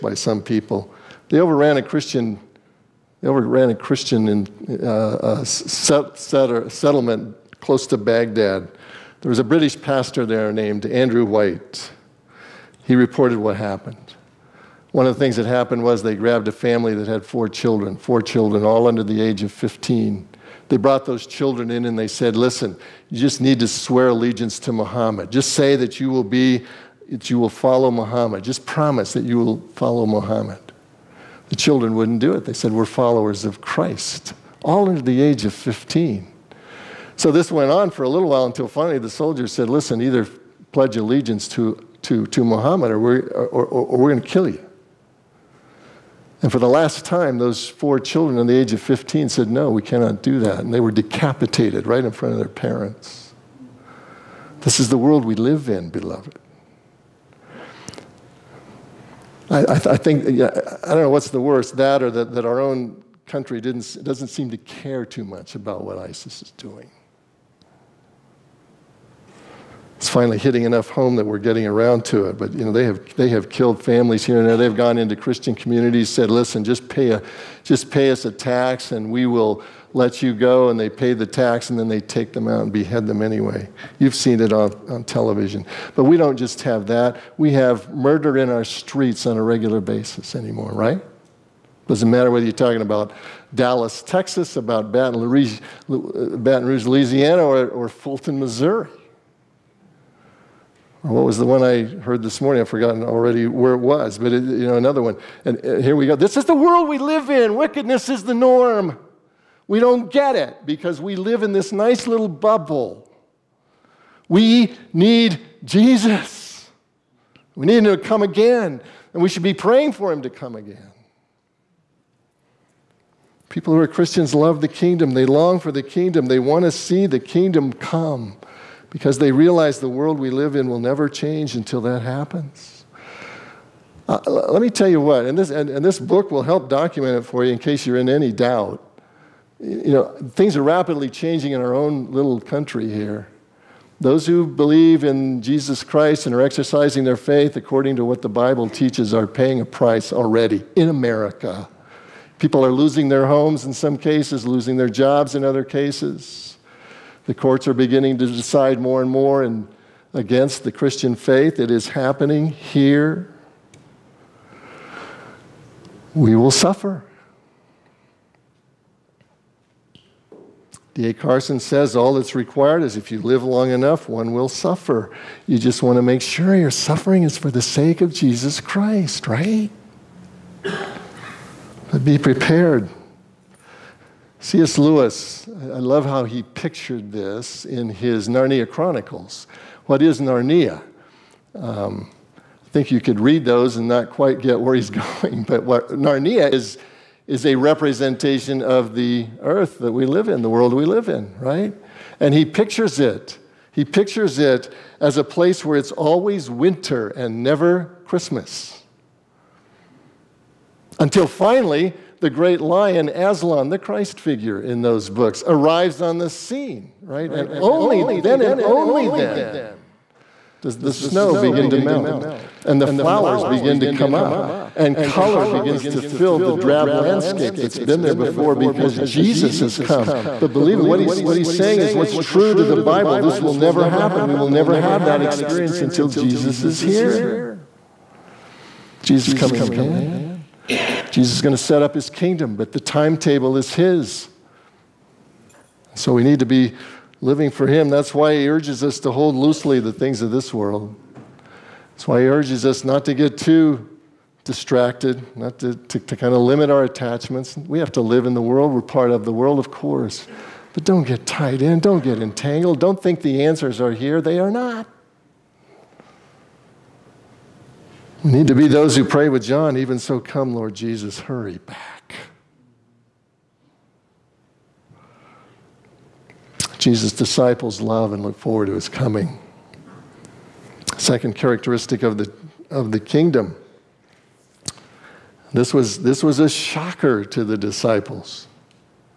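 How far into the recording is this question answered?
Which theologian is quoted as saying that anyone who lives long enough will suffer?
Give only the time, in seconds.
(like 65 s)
170 s.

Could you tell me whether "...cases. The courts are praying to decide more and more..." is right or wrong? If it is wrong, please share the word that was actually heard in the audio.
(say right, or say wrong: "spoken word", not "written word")
wrong: "beginning", not "praying".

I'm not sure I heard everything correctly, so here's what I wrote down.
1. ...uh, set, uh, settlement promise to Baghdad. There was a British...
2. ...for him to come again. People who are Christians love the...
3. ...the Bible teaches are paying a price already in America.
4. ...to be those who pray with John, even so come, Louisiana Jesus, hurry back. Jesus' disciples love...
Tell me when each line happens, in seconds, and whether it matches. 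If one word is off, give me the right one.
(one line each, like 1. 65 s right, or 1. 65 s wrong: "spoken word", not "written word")
1. 5 s wrong: "close", not "promise"
2. 119 s right
3. 148 s right
4. 268 s wrong: "Lord", not "Louisiana".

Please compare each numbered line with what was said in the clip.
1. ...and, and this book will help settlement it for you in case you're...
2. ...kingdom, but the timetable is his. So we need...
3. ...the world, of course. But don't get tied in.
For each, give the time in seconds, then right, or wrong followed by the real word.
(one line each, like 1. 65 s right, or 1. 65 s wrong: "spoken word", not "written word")
1. 135 s wrong: "document", not "settlement"
2. 242 s right
3. 259 s right.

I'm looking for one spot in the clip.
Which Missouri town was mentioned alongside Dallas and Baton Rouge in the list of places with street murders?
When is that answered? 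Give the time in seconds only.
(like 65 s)
97 s.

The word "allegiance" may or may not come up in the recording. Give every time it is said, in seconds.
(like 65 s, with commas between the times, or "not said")
24 s, 40 s.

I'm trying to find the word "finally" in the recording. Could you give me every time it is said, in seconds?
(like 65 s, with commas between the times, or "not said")
38 s, 70 s, 211 s.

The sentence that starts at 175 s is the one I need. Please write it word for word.
You just want to make sure your suffering is for the sake of Jesus Christ, right?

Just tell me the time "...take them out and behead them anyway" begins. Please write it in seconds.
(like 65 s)
81 s.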